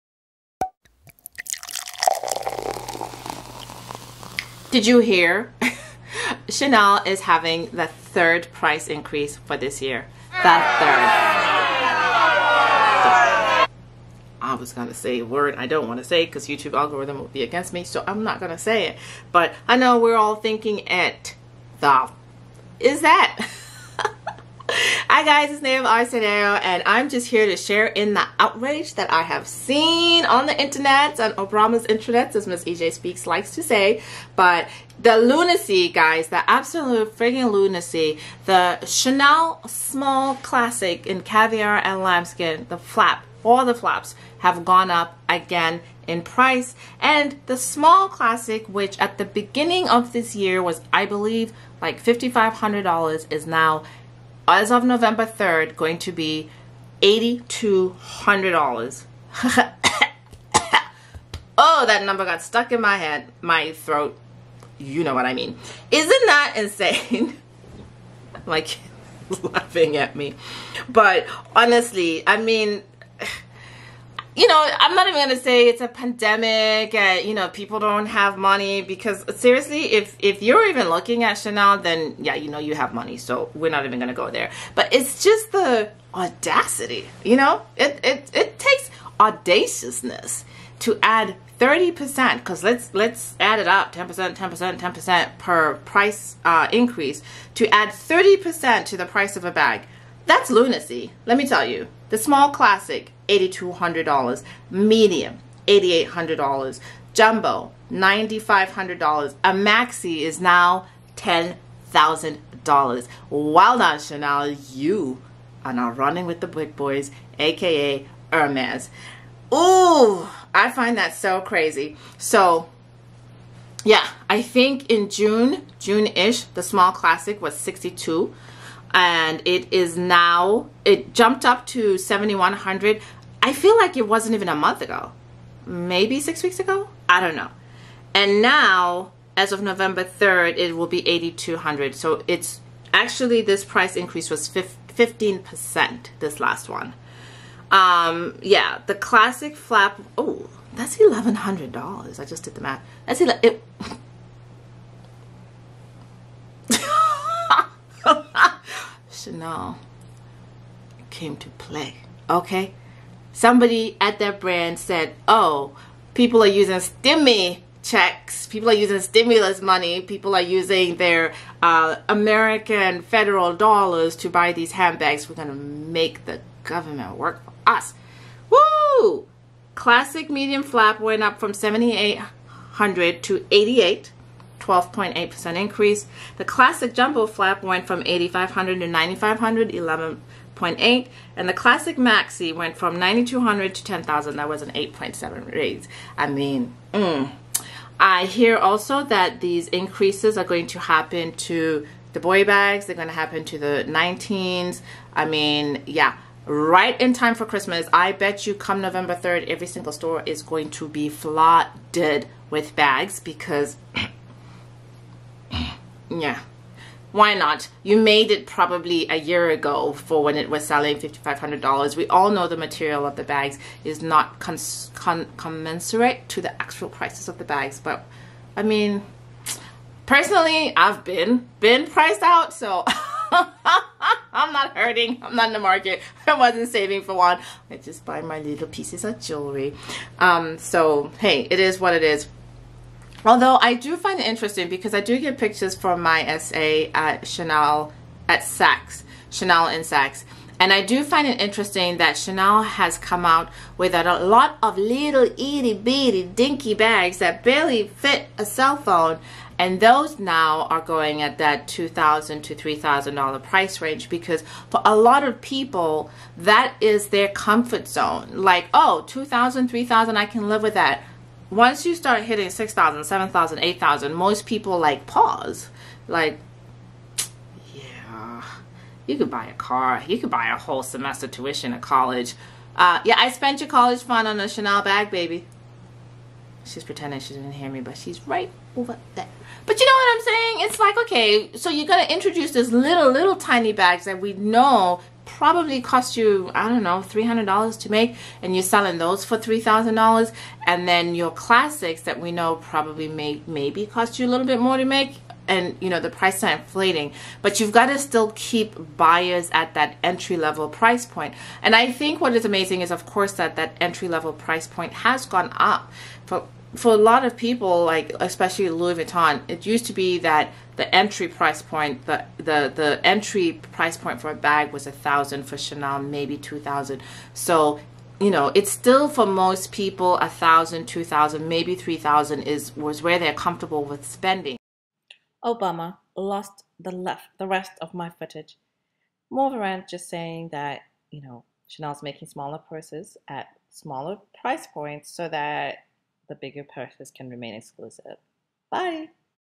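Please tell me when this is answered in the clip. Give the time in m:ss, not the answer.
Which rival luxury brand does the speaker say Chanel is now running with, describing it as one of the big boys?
1:58.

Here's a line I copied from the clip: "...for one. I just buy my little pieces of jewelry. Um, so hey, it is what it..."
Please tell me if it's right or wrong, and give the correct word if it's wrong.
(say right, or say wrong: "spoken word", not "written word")
right.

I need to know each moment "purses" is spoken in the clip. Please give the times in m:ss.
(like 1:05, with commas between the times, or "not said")
5:42, 5:46.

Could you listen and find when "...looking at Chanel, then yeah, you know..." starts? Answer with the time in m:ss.
1:20.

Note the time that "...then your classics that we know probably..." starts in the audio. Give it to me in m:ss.
5:00.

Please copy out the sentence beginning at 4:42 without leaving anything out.
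Uh, yeah, I spent your college fund on a Chanel bag, baby.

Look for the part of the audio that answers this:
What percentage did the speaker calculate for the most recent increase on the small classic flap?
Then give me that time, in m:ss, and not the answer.
2:24.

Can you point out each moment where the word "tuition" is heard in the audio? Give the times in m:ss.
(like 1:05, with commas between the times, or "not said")
4:41.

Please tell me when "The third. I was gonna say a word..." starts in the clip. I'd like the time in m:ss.
0:10.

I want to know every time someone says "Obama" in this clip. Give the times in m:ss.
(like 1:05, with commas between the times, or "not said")
0:31, 5:35.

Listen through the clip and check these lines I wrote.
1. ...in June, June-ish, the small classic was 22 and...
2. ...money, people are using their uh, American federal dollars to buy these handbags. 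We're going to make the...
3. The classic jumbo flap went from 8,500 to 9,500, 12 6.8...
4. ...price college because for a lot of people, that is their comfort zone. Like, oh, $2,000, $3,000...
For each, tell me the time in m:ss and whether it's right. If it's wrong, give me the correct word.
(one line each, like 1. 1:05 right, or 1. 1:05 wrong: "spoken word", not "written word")
1. 2:04 wrong: "62", not "22"
2. 2:49 right
3. 3:06 wrong: "11", not "12"
4. 4:23 wrong: "range", not "college".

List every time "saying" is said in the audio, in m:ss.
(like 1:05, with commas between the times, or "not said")
4:50, 5:40.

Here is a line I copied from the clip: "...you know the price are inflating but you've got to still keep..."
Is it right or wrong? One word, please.
right.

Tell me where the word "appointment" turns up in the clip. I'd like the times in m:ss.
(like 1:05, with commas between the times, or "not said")
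not said.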